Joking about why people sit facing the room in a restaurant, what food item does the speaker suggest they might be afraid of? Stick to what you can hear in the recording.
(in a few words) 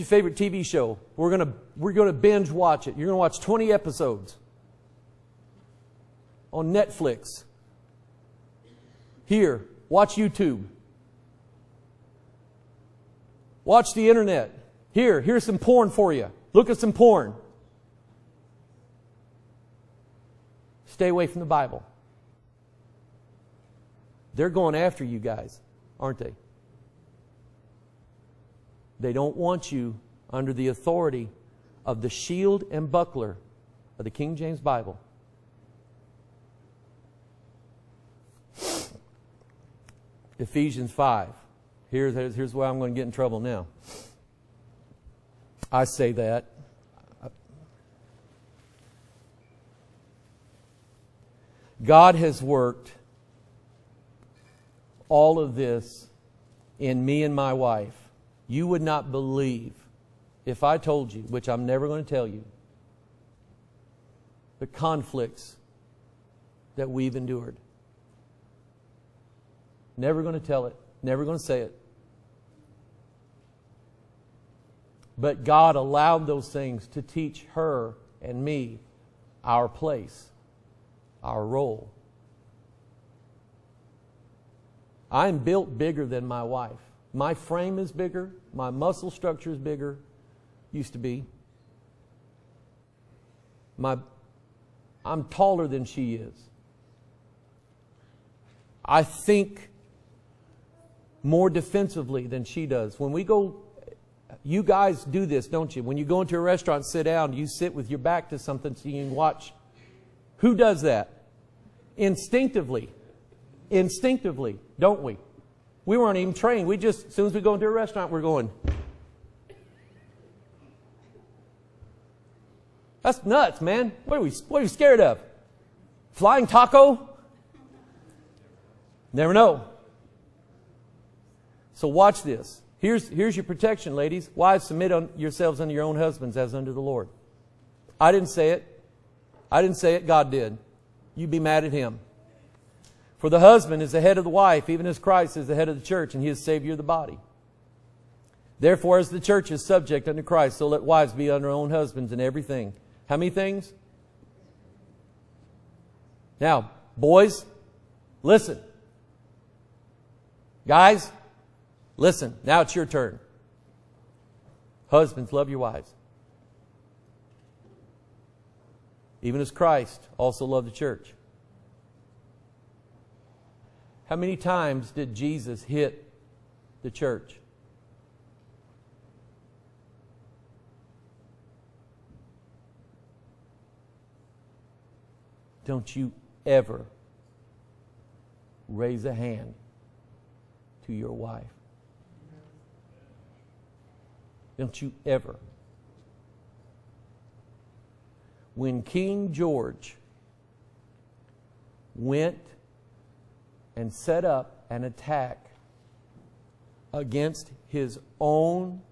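Flying taco.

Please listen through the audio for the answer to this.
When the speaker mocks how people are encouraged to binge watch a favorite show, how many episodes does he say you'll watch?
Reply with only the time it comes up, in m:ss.
0:03.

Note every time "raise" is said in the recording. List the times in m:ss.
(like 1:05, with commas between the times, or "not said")
3:08.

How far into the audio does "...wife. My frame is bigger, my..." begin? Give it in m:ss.
1:26.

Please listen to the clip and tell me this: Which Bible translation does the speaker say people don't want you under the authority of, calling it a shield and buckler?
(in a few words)
King James Bible.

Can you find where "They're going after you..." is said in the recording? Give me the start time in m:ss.
0:24.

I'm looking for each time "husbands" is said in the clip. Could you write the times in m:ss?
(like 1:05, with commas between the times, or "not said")
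2:15, 2:23, 2:31, 2:44.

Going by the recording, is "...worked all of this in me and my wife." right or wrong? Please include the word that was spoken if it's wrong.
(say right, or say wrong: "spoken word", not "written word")
right.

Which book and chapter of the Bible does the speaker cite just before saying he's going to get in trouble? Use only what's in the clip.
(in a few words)
Ephesians 5.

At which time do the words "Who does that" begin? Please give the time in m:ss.
1:50.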